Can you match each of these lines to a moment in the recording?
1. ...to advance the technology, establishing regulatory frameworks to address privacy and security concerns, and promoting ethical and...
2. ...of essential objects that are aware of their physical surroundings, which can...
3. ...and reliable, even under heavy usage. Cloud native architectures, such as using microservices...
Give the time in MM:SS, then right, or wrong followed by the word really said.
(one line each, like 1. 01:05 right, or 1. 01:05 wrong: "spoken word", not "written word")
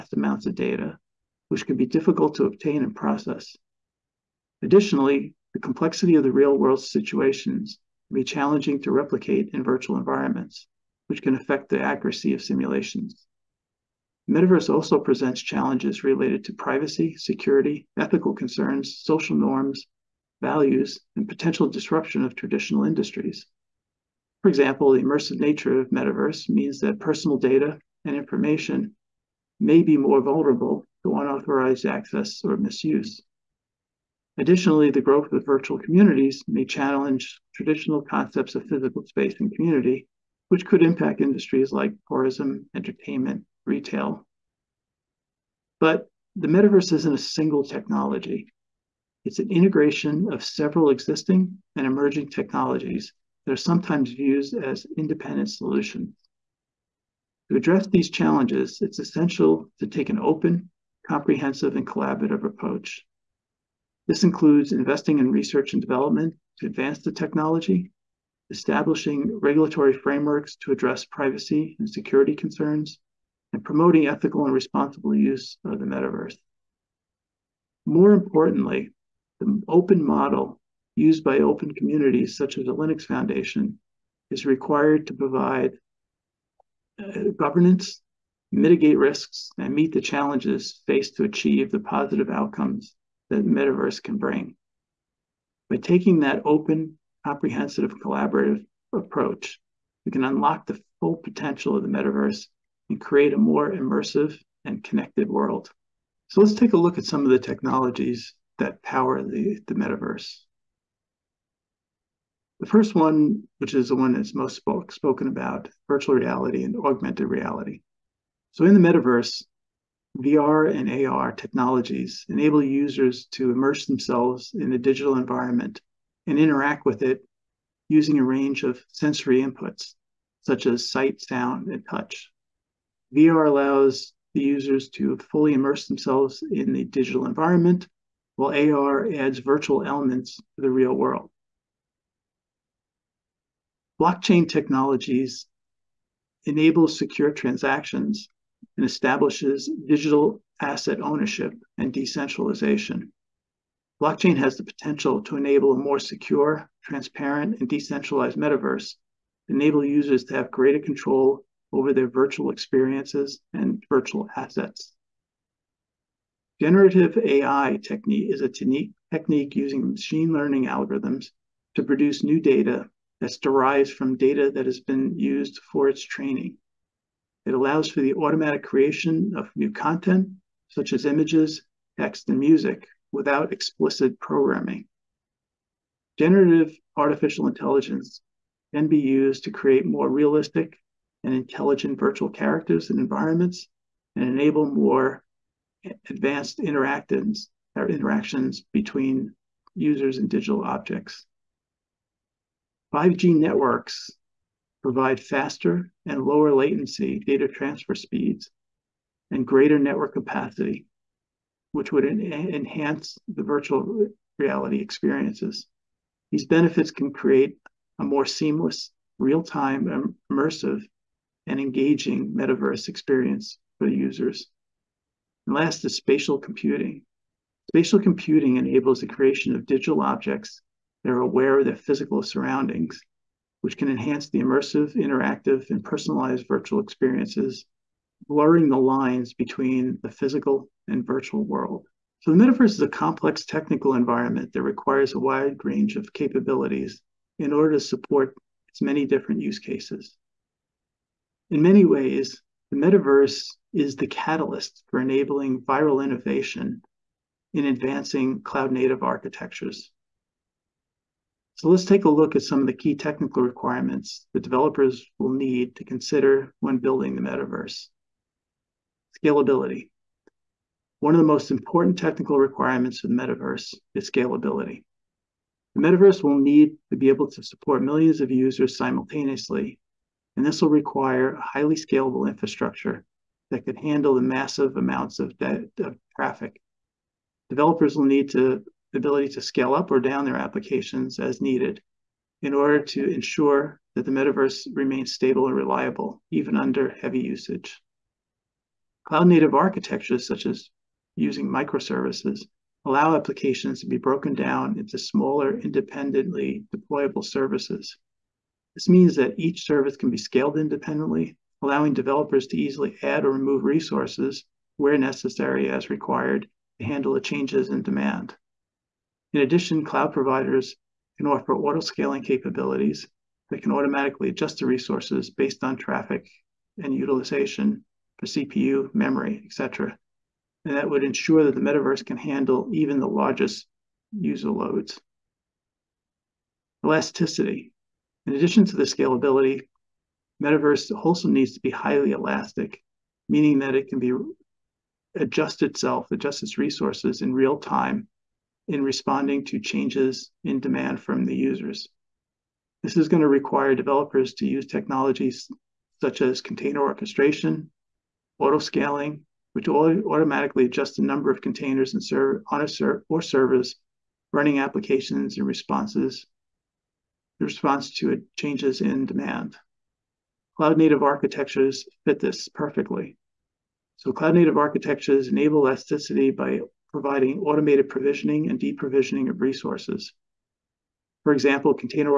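1. 01:06 right
2. 03:49 wrong: "digital", not "essential"
3. 04:55 right.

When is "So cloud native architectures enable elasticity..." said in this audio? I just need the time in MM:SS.
06:13.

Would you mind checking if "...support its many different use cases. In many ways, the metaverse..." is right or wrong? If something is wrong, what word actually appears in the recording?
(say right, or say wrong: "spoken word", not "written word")
right.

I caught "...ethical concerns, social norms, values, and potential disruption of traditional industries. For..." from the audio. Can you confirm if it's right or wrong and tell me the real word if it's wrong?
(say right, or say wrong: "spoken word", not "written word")
right.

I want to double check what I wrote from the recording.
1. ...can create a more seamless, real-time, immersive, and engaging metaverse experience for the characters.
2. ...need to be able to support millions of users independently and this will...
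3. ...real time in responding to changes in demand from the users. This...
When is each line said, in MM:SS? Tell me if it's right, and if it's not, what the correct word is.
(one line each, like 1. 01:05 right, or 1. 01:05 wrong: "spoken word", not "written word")
1. 03:36 wrong: "users", not "characters"
2. 04:36 wrong: "simultaneously", not "independently"
3. 05:47 right.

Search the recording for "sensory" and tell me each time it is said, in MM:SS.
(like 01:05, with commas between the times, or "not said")
02:08.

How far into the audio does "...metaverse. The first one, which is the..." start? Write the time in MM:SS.
01:49.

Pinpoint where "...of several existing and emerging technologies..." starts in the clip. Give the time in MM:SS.
00:50.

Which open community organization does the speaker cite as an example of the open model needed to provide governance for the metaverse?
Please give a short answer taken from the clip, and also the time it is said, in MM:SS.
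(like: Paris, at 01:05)
Linux Foundation, at 01:22.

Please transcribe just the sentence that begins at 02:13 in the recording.
VR allows the users to fully immerse themselves in the digital environment, while AR adds virtual elements to the real world.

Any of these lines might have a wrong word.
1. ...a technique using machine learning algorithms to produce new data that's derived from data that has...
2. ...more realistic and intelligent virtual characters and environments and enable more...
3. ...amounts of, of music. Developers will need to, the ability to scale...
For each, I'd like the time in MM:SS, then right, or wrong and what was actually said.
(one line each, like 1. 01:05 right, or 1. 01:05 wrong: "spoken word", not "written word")
1. 02:48 right
2. 03:09 right
3. 04:44 wrong: "traffic", not "music".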